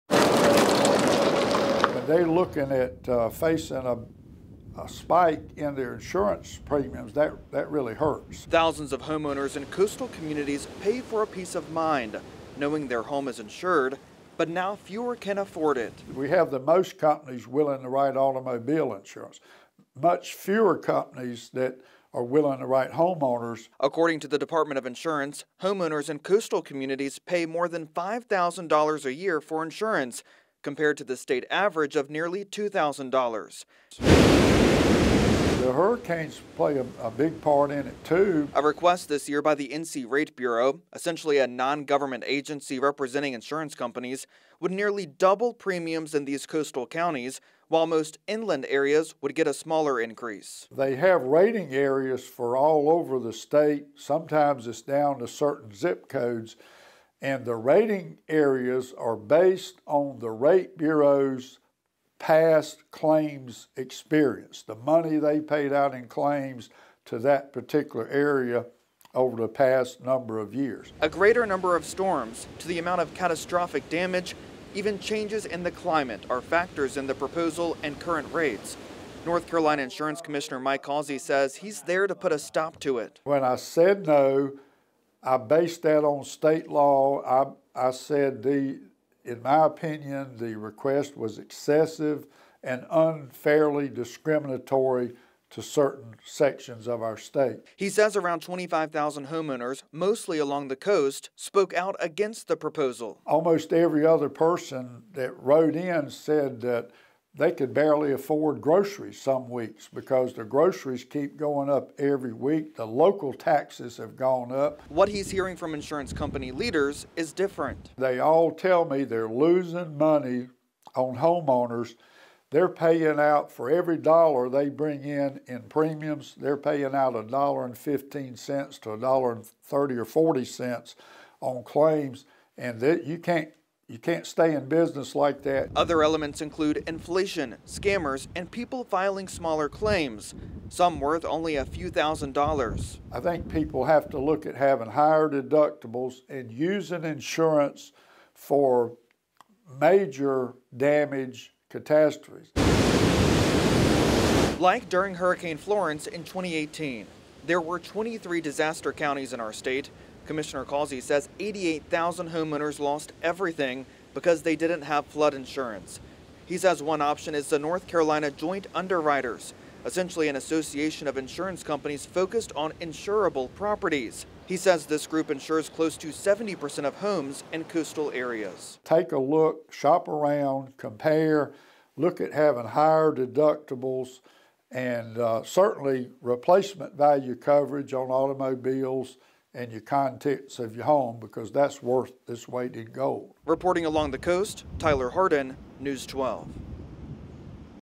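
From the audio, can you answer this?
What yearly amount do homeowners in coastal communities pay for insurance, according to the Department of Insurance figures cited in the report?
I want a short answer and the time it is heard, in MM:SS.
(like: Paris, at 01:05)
more than $5,000, at 00:27.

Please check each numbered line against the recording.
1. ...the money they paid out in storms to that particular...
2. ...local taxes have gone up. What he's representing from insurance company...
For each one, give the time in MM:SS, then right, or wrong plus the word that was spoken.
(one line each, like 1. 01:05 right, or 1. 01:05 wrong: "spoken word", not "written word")
1. 01:04 wrong: "claims", not "storms"
2. 01:52 wrong: "hearing", not "representing".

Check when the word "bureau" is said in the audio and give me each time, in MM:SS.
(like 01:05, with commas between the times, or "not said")
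00:40, 01:00.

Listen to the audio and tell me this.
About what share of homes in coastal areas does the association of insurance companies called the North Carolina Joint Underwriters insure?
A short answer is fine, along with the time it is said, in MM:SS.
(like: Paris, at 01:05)
close to 70%, at 02:55.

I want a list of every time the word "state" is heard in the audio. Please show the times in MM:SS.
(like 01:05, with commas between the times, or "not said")
00:31, 00:53, 01:26, 01:37, 02:39.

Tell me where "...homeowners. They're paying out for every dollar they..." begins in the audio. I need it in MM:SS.
02:01.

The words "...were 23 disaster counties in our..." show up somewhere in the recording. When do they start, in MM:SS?
02:37.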